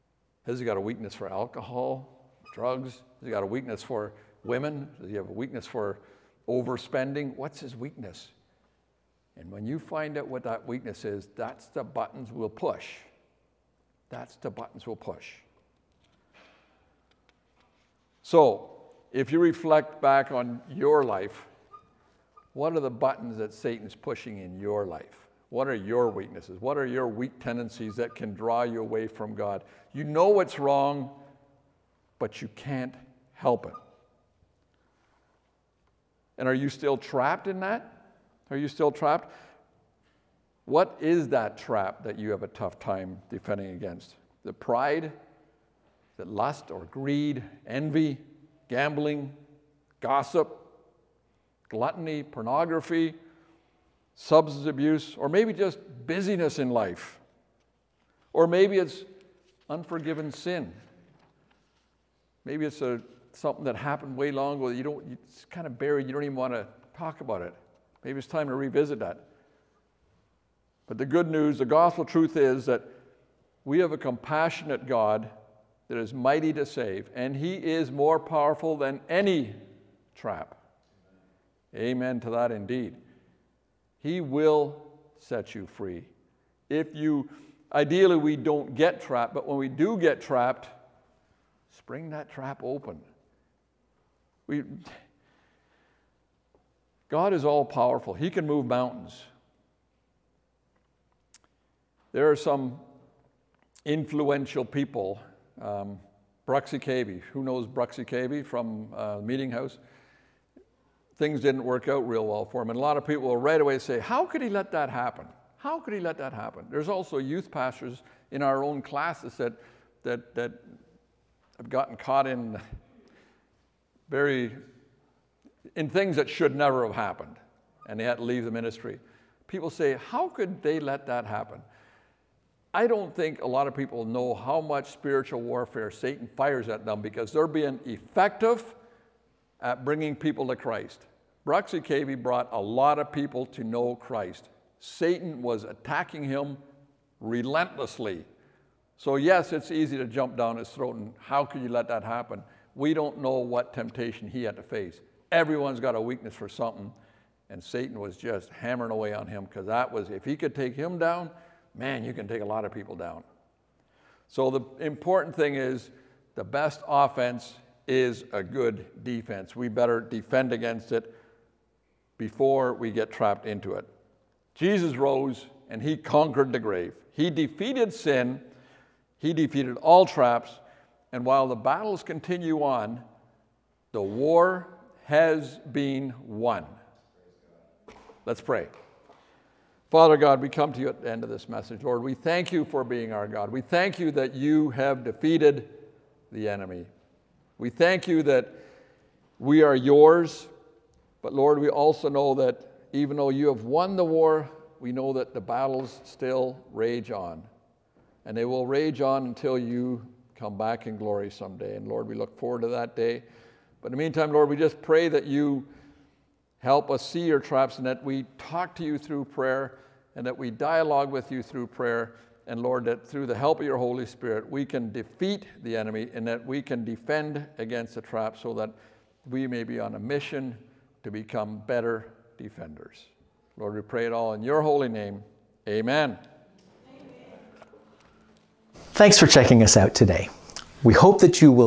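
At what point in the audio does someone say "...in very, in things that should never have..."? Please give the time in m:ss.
2:02.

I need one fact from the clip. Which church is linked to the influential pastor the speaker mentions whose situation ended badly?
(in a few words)
Meeting House.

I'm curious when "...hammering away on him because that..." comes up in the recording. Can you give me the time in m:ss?
2:38.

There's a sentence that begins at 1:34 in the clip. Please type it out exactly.
We, God is all powerful, He can move mountains.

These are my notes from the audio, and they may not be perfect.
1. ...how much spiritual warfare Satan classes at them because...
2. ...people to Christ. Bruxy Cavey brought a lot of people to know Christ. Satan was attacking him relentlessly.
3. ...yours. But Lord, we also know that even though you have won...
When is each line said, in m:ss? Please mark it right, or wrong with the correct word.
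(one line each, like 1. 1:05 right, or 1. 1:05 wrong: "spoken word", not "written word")
1. 2:14 wrong: "fires", not "classes"
2. 2:20 right
3. 3:19 right.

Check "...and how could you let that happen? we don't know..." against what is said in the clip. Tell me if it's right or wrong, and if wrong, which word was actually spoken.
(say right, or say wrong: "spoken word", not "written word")
right.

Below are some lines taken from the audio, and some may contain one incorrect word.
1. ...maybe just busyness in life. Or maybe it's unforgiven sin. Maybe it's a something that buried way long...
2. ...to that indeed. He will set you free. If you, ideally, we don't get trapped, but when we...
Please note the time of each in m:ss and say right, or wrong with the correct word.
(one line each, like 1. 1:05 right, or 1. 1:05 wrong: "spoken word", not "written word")
1. 0:55 wrong: "happened", not "buried"
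2. 1:22 right.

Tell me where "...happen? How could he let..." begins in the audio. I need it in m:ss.
1:54.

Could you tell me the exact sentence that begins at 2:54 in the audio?
Jesus rose and he conquered the grave.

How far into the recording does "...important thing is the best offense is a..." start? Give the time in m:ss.
2:44.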